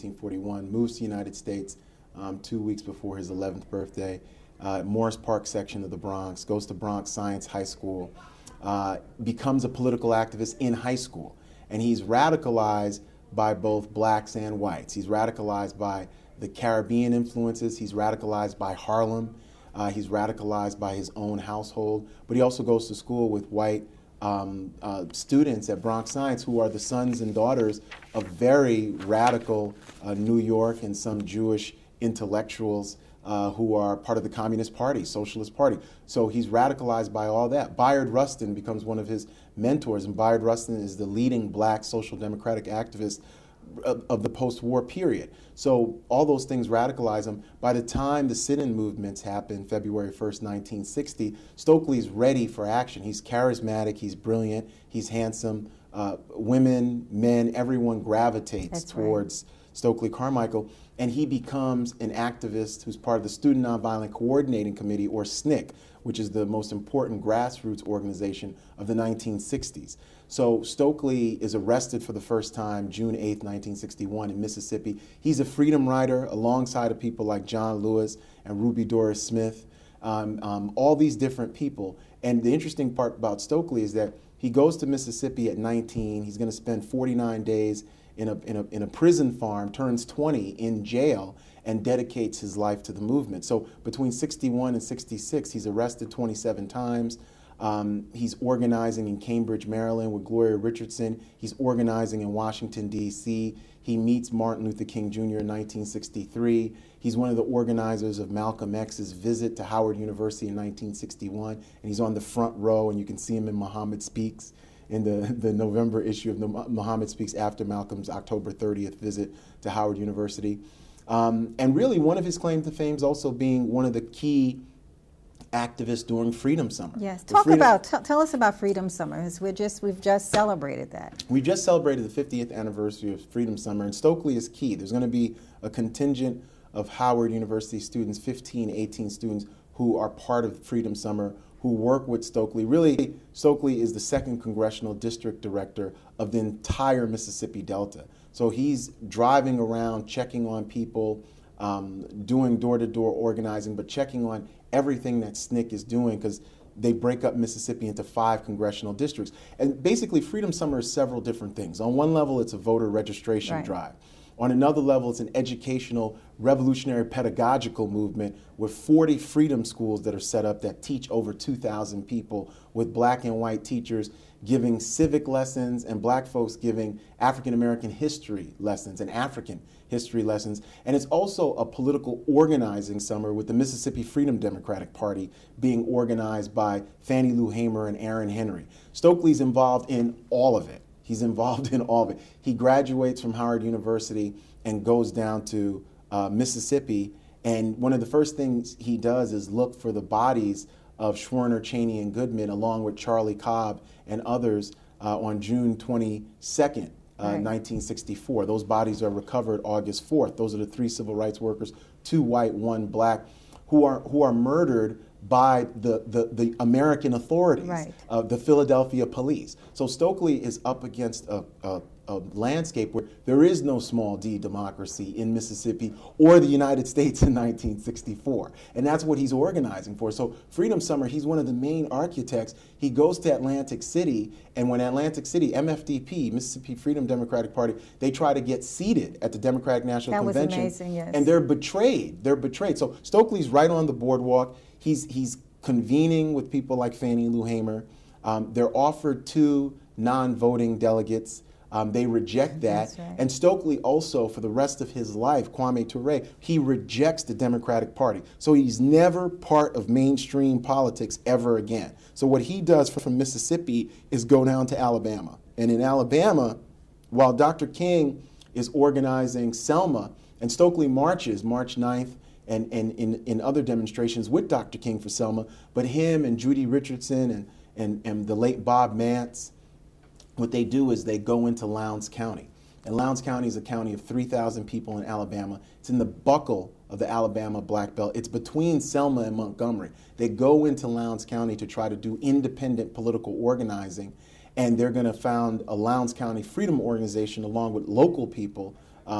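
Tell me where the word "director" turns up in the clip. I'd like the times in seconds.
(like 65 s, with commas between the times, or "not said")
145 s.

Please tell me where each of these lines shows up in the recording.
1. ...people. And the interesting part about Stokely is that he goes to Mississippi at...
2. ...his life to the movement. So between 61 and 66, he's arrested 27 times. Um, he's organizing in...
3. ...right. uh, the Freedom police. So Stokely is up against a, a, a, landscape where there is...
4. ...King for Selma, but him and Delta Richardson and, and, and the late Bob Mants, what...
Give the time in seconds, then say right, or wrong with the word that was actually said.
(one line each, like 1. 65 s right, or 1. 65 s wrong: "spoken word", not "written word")
1. 81 s right
2. 92 s right
3. 217 s wrong: "Philadelphia", not "Freedom"
4. 274 s wrong: "Judy", not "Delta".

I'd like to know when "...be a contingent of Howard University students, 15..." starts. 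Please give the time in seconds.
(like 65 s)
135 s.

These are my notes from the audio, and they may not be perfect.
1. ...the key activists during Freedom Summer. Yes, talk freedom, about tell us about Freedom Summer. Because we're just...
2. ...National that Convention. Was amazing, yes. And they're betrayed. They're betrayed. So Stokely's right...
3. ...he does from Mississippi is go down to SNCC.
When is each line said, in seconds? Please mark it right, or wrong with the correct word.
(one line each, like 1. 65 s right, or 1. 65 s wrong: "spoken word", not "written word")
1. 123 s right
2. 239 s right
3. 262 s wrong: "Alabama", not "SNCC".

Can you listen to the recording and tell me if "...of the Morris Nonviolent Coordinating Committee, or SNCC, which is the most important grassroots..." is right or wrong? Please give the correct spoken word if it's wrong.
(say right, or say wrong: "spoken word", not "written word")
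wrong: "Student", not "Morris".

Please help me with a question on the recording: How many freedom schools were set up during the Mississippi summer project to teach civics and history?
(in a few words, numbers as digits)
40.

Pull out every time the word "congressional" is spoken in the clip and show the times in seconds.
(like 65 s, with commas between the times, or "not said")
144 s, 158 s.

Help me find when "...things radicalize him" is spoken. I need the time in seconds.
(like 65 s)
46 s.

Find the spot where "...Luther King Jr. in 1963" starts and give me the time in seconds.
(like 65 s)
104 s.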